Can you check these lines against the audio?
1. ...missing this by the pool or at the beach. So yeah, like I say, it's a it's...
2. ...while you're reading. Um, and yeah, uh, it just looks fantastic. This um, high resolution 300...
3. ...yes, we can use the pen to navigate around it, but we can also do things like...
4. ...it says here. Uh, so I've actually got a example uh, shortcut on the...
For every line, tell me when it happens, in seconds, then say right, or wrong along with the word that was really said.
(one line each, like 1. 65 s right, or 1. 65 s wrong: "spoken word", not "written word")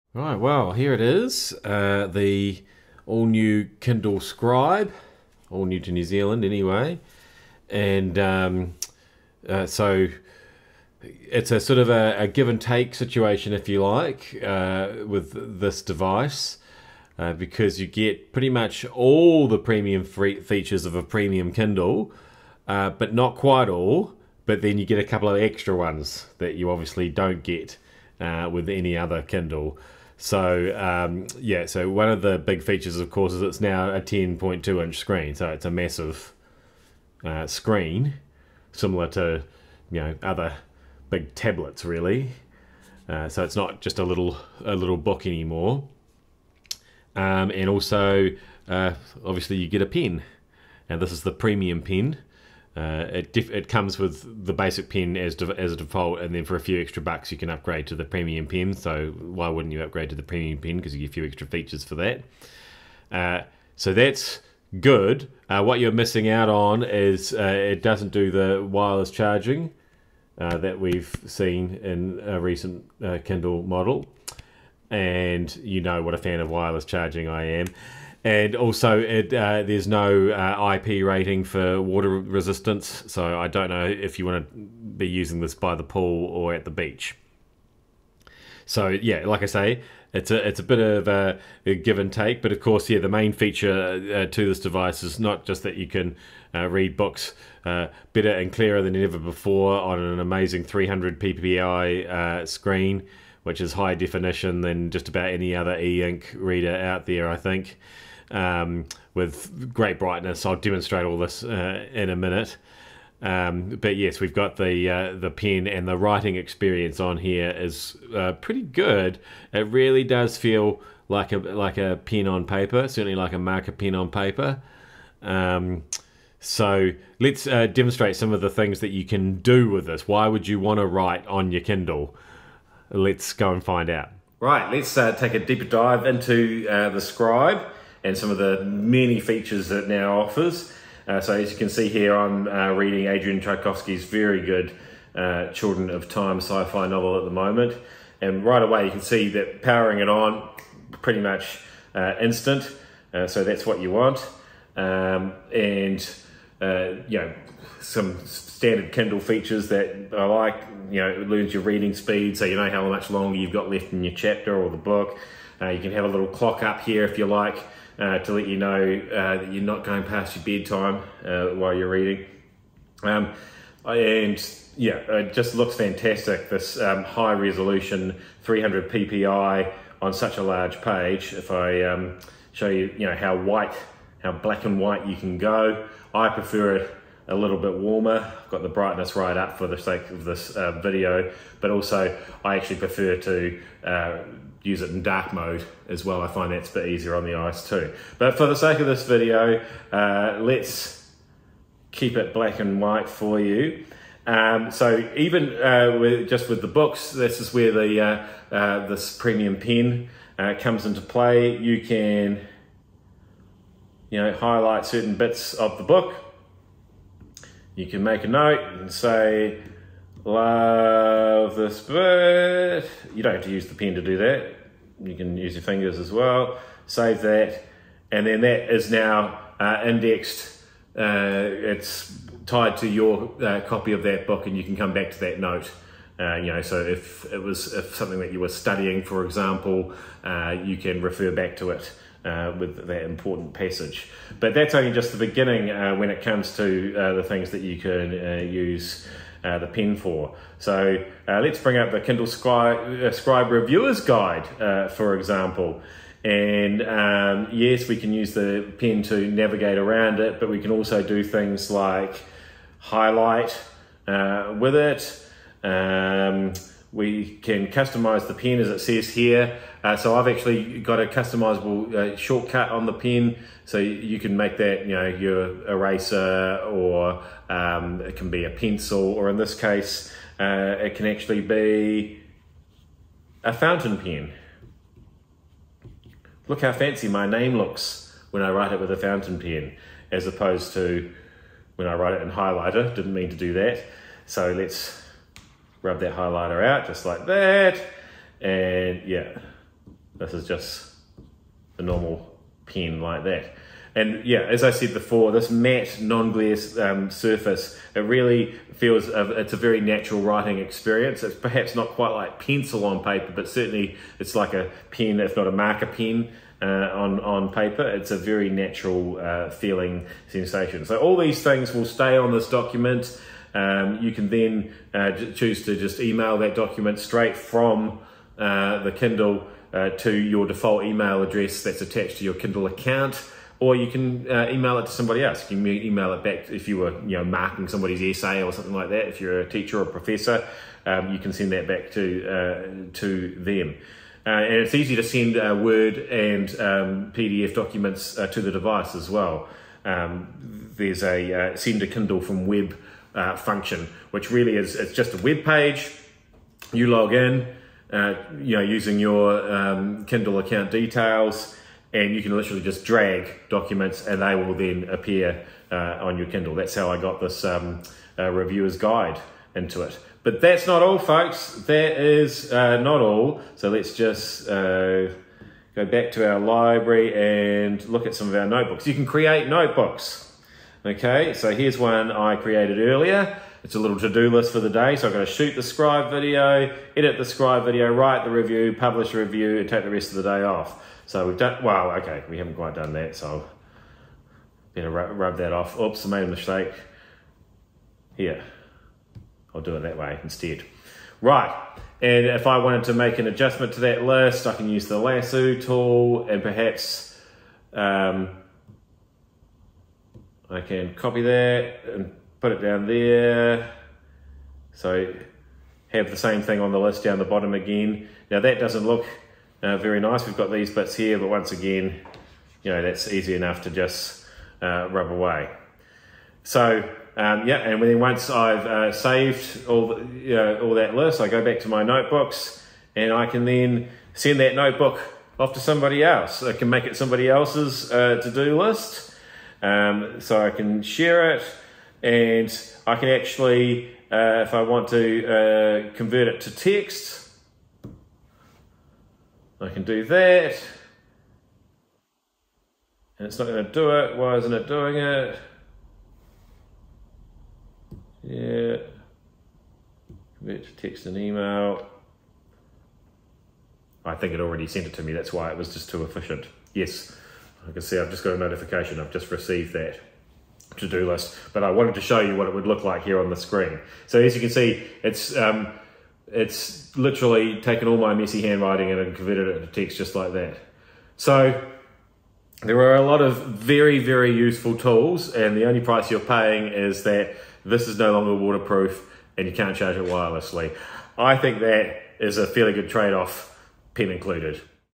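1. 85 s wrong: "using", not "missing"
2. 171 s right
3. 257 s right
4. 268 s wrong: "customizable", not "example".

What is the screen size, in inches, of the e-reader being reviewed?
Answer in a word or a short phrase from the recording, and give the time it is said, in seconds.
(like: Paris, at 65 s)
10.2 inches, at 33 s.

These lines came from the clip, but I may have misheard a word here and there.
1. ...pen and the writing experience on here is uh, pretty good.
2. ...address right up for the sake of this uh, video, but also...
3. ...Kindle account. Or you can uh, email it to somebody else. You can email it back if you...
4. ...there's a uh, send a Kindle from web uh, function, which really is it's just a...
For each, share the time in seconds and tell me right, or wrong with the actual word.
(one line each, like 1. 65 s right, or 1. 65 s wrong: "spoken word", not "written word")
1. 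115 s right
2. 188 s wrong: "brightness", not "address"
3. 332 s right
4. 350 s right.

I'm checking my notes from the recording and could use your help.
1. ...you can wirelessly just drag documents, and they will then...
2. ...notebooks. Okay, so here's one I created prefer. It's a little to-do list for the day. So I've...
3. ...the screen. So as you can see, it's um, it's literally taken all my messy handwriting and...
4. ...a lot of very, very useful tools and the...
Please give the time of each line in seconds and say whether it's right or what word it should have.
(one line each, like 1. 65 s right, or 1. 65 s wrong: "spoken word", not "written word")
1. 362 s wrong: "literally", not "wirelessly"
2. 379 s wrong: "earlier", not "prefer"
3. 473 s right
4. 482 s right.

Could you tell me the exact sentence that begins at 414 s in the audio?
So have the same thing on the list down the bottom again.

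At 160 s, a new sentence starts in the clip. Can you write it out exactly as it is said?
You know, it learns your reading speed, so you know how much longer you've got left in your chapter or the book.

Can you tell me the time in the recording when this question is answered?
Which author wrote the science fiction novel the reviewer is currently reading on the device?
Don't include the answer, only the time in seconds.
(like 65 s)
143 s.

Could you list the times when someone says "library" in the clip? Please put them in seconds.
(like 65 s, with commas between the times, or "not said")
376 s.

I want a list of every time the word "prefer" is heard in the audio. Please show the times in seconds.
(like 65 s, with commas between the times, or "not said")
186 s, 192 s.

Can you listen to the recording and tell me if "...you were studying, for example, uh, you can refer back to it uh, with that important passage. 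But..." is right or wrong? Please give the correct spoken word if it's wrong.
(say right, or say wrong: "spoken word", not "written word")
right.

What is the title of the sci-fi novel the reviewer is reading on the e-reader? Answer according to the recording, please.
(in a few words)
Children of Time.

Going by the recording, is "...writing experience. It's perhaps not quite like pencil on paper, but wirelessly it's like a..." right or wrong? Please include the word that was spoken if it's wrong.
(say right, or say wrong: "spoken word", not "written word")
wrong: "certainly", not "wirelessly".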